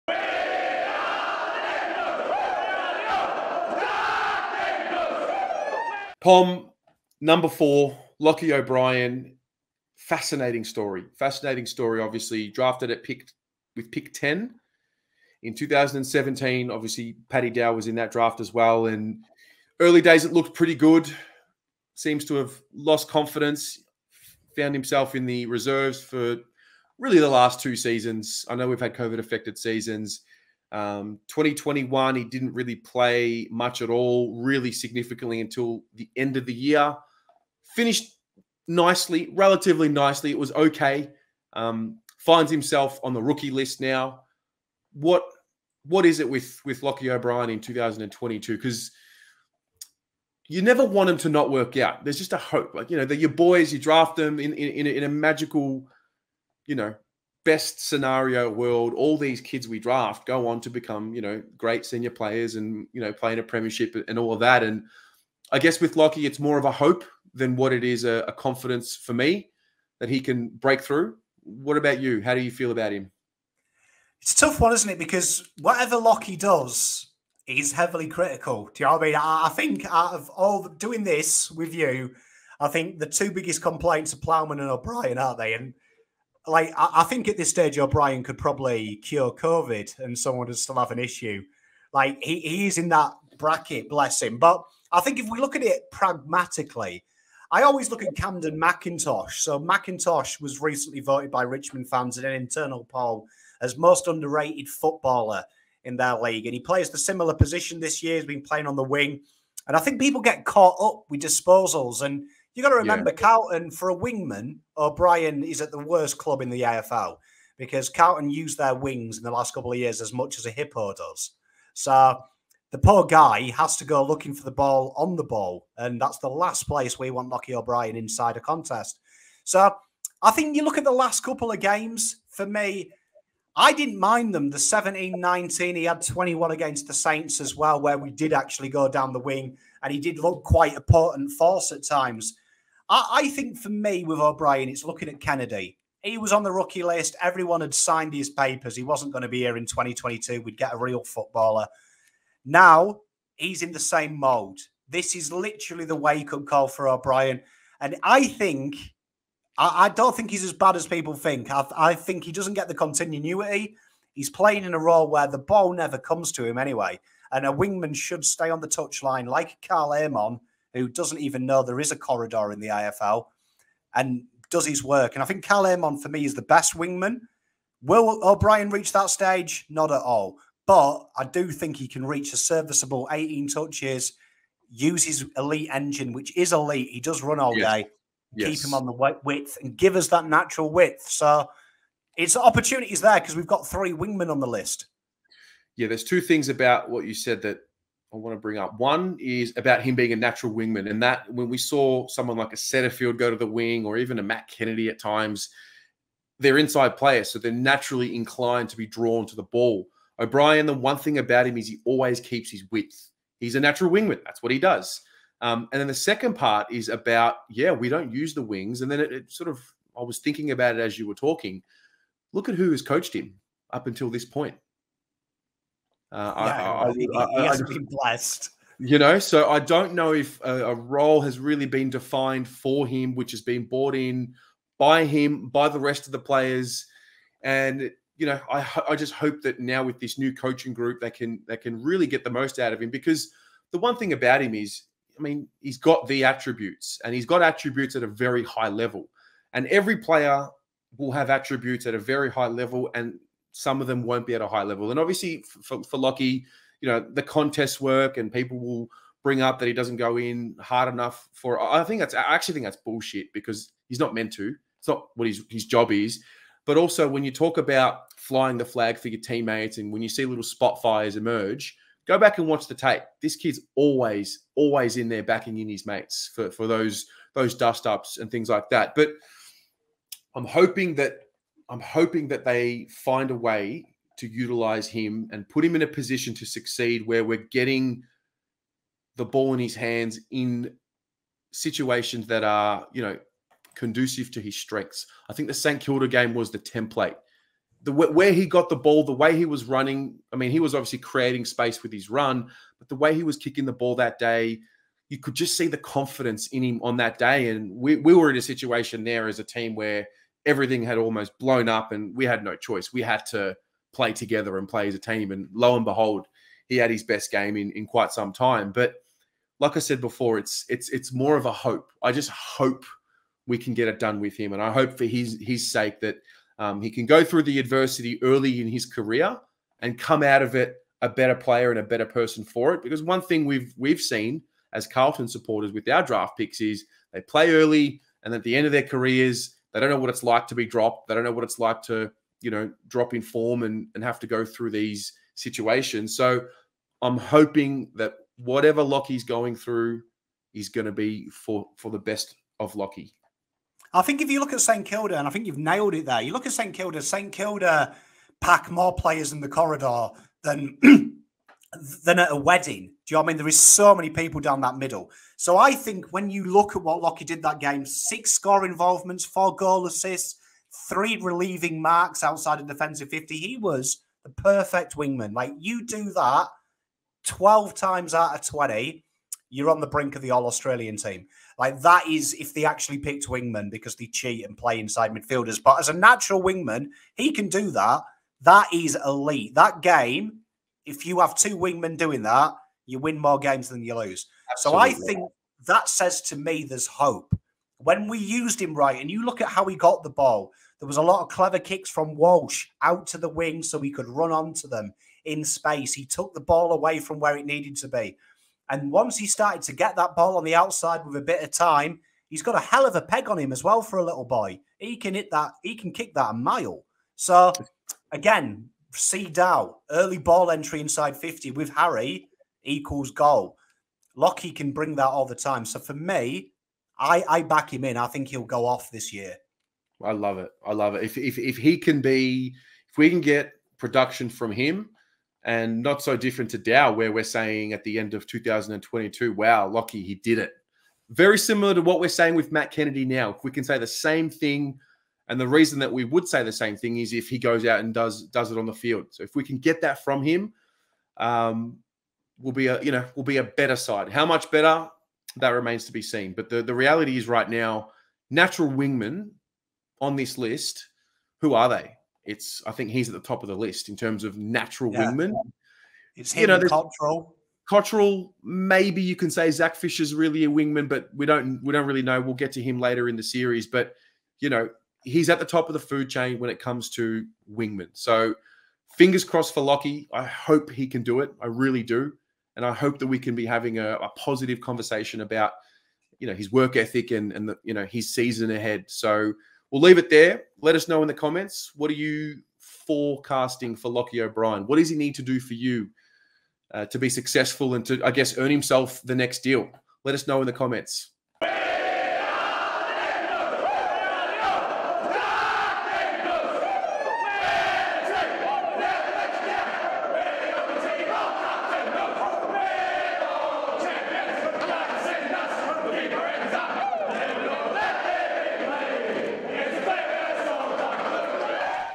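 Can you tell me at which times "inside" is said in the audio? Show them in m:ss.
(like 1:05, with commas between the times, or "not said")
2:07, 3:26, 6:24, 7:00.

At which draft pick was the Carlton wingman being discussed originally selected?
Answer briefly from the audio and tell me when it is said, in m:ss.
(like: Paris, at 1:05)
10, at 0:13.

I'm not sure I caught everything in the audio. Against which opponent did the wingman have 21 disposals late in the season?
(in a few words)
Saints.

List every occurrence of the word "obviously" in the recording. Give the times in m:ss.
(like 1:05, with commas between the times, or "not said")
0:11, 0:16, 4:14, 5:00.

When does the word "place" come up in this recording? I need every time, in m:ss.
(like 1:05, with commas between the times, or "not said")
2:06.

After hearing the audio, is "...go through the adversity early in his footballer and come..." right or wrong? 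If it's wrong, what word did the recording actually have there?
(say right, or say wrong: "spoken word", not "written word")
wrong: "career", not "footballer".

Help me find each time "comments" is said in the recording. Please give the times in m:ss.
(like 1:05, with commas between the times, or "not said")
8:11, 8:20.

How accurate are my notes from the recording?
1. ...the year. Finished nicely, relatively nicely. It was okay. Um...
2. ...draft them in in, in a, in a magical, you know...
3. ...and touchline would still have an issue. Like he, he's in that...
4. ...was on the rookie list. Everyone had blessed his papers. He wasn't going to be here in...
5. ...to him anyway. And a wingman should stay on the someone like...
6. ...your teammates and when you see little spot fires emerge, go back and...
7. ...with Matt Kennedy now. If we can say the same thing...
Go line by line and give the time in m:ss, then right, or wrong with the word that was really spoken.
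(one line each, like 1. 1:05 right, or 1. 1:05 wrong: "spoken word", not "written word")
1. 0:36 right
2. 0:53 right
3. 1:29 wrong: "someone", not "touchline"
4. 2:26 wrong: "signed", not "blessed"
5. 2:46 wrong: "touchline", not "someone"
6. 4:29 right
7. 7:22 right.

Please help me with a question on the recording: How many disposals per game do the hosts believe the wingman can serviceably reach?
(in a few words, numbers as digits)
18.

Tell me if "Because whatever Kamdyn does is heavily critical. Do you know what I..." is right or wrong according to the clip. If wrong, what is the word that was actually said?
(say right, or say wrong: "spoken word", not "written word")
wrong: "Lochie", not "Kamdyn".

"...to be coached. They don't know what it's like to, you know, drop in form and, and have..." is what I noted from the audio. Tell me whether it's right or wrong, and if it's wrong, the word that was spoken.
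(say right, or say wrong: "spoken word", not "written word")
wrong: "dropped", not "coached".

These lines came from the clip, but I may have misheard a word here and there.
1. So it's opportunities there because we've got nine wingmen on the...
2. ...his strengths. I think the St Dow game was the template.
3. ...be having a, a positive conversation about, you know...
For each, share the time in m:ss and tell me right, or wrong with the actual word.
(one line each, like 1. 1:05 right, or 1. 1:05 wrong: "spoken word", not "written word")
1. 3:11 wrong: "three", not "nine"
2. 4:54 wrong: "Kilda", not "Dow"
3. 8:03 right.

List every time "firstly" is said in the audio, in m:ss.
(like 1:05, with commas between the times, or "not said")
not said.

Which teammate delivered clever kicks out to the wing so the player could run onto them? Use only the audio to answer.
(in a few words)
Walsh.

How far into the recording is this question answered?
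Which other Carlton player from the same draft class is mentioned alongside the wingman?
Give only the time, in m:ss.
0:17.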